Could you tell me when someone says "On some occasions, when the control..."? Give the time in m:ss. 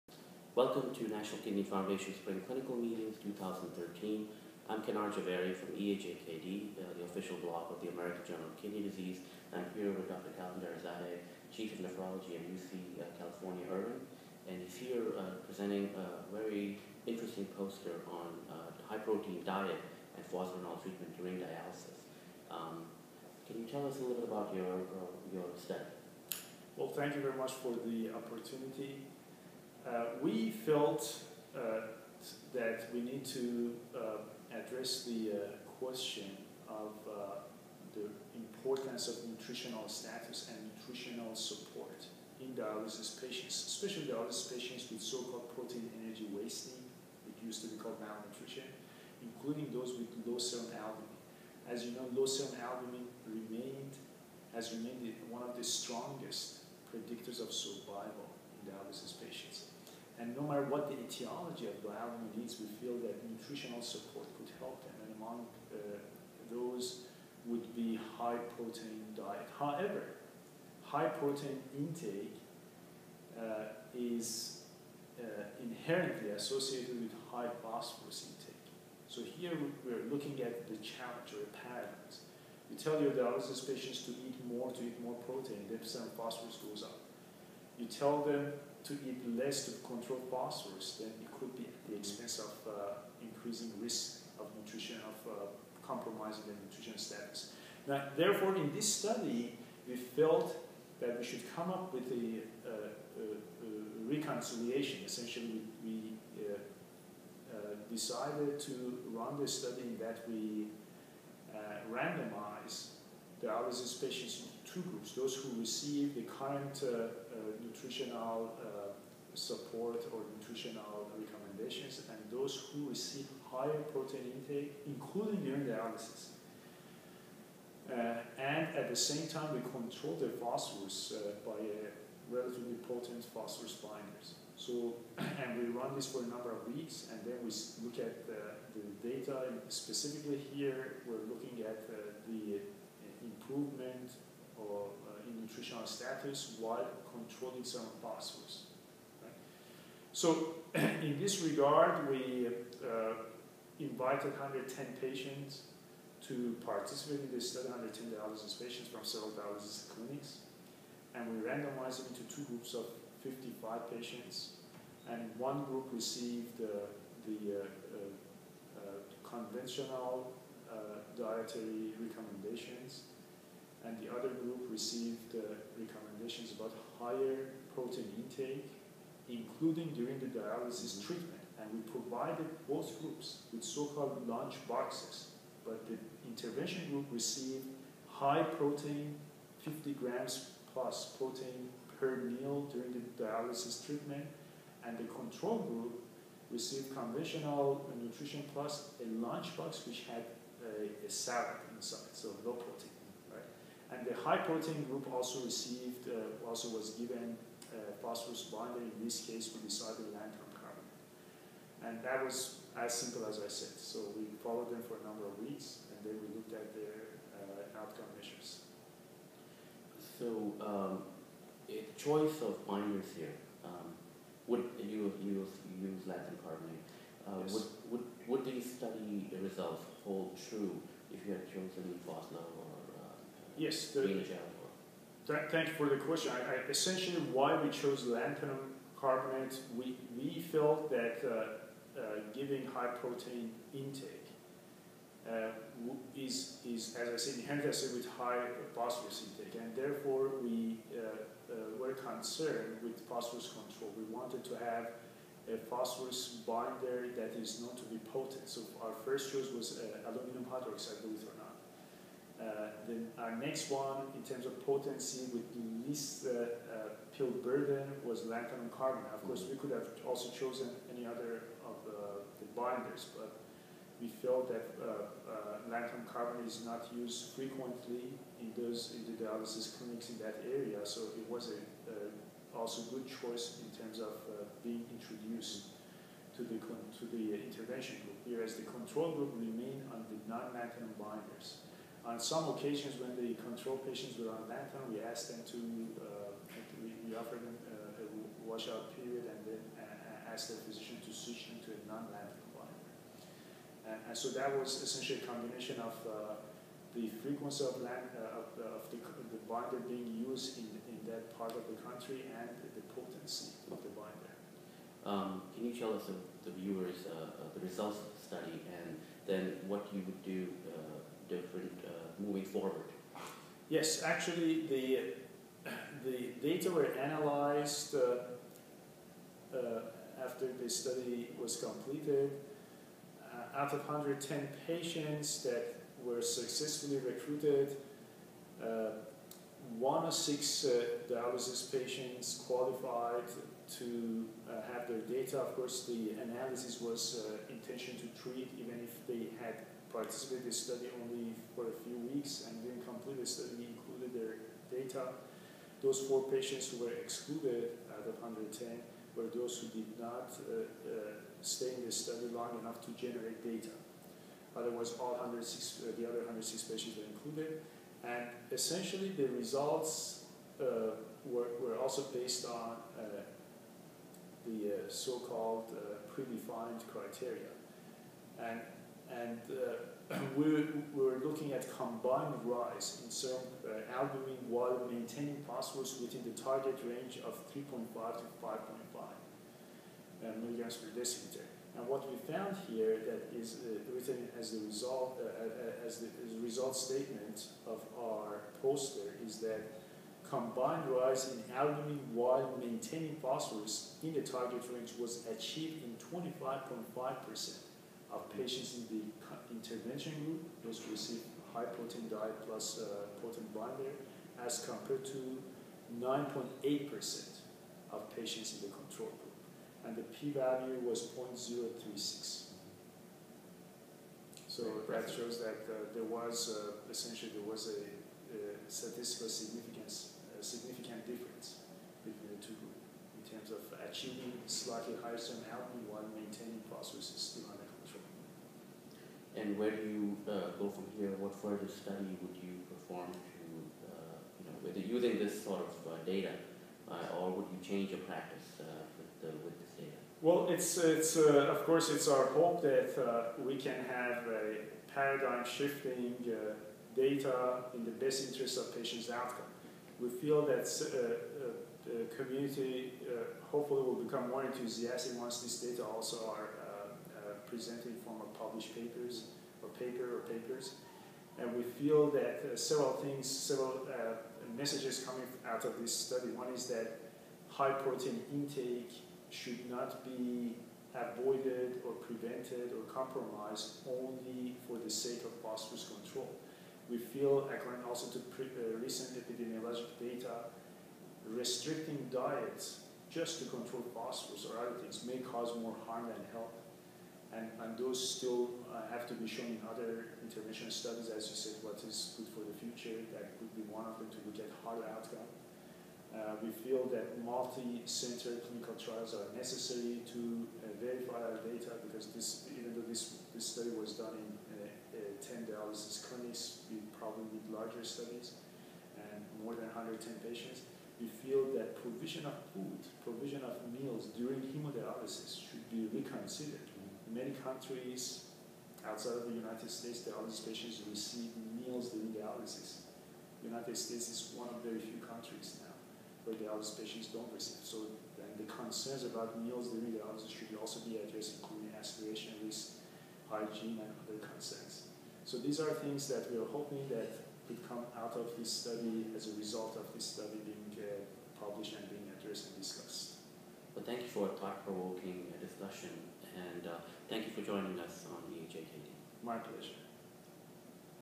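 4:52.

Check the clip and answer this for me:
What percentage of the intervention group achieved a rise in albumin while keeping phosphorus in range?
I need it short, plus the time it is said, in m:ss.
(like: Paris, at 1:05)
25.5%, at 6:45.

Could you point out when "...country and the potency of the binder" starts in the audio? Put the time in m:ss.
5:11.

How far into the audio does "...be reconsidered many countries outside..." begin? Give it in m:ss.
8:45.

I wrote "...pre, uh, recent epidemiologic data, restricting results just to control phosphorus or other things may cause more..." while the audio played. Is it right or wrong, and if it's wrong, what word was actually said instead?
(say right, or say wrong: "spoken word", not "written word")
wrong: "diets", not "results".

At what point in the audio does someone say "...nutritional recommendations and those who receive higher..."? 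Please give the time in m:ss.
2:00.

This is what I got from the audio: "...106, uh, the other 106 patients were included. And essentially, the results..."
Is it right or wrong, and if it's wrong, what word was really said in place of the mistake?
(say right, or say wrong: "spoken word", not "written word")
right.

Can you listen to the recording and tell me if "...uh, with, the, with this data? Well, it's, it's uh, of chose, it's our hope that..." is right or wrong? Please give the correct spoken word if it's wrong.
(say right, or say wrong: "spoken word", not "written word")
wrong: "course", not "chose".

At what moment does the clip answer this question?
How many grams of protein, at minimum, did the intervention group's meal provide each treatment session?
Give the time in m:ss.
3:09.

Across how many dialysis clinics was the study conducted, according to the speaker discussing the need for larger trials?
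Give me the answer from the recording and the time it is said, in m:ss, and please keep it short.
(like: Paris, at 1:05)
10, at 8:35.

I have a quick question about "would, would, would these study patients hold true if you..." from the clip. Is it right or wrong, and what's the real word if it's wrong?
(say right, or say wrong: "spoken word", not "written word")
wrong: "results", not "patients".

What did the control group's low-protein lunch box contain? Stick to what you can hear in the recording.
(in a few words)
A salad.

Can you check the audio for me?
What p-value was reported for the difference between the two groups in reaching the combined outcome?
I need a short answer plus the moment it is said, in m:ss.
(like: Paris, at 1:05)
0.036, at 7:01.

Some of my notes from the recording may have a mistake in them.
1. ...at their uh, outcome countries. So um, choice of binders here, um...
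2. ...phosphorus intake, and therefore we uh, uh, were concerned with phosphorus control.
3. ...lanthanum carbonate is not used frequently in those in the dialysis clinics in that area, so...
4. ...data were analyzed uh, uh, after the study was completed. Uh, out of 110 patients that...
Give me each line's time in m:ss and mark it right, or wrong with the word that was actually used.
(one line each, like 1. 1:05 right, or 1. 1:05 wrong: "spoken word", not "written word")
1. 3:36 wrong: "measures", not "countries"
2. 4:08 right
3. 4:35 right
4. 5:26 right.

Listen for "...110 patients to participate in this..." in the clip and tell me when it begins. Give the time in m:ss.
2:34.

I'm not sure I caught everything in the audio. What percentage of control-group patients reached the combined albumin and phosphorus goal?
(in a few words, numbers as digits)
9.8%.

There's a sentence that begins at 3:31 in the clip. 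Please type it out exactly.
And that was as simple as I said.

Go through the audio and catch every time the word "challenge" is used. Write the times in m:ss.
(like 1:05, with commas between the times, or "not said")
1:20.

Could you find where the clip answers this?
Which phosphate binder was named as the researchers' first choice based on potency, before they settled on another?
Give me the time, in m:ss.
4:20.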